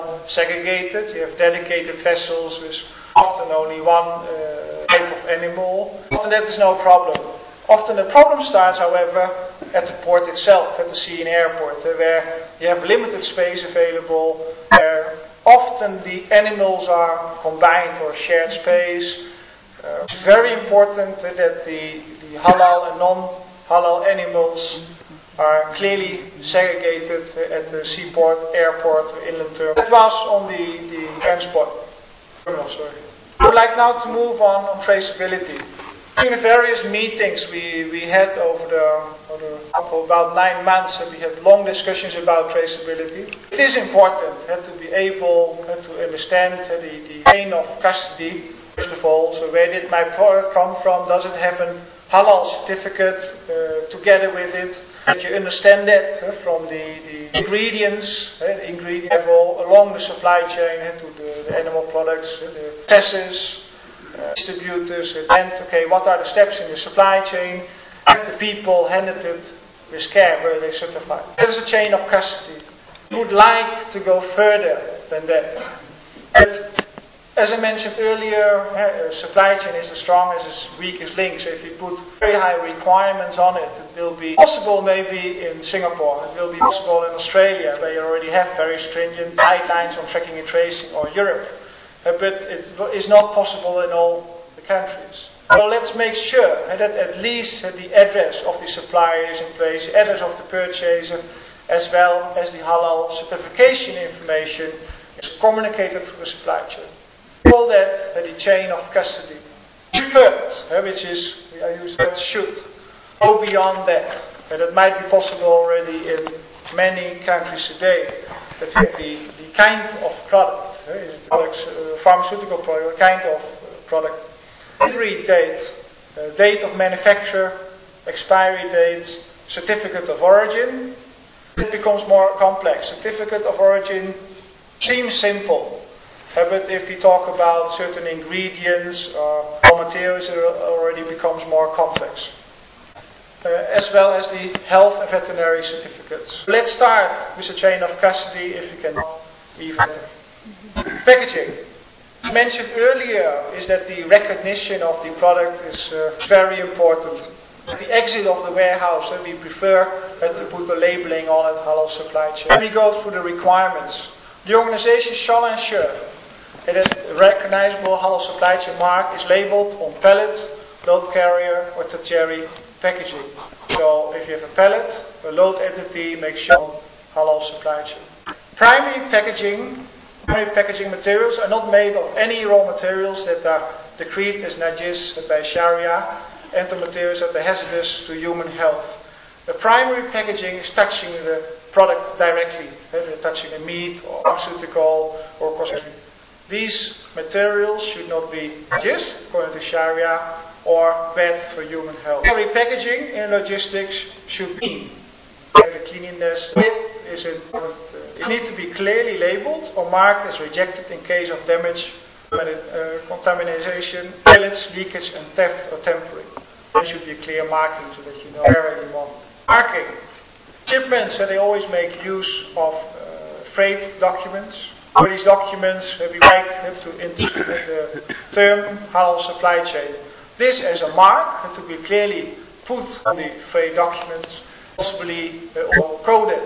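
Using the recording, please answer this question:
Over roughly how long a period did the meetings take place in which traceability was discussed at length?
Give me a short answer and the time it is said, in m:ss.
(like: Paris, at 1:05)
9 months, at 0:40.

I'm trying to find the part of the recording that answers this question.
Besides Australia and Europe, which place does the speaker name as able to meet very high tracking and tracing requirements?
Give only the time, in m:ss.
1:25.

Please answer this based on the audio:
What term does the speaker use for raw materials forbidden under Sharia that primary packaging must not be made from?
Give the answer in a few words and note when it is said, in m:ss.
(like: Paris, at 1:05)
najis, at 3:04.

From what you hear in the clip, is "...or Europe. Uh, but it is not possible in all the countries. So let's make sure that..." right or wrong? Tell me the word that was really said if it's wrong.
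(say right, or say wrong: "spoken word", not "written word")
right.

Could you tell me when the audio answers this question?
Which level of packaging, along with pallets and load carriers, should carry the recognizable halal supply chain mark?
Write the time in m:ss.
2:51.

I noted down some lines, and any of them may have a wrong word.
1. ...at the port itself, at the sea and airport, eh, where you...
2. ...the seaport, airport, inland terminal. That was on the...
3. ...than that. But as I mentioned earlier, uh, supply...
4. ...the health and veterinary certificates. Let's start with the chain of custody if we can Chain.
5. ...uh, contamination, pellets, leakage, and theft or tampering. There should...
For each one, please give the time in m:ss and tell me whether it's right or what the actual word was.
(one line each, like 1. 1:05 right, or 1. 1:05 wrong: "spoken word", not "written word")
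1. 0:09 right
2. 0:27 right
3. 1:15 right
4. 2:24 wrong: "Packaging", not "Chain"
5. 3:32 right.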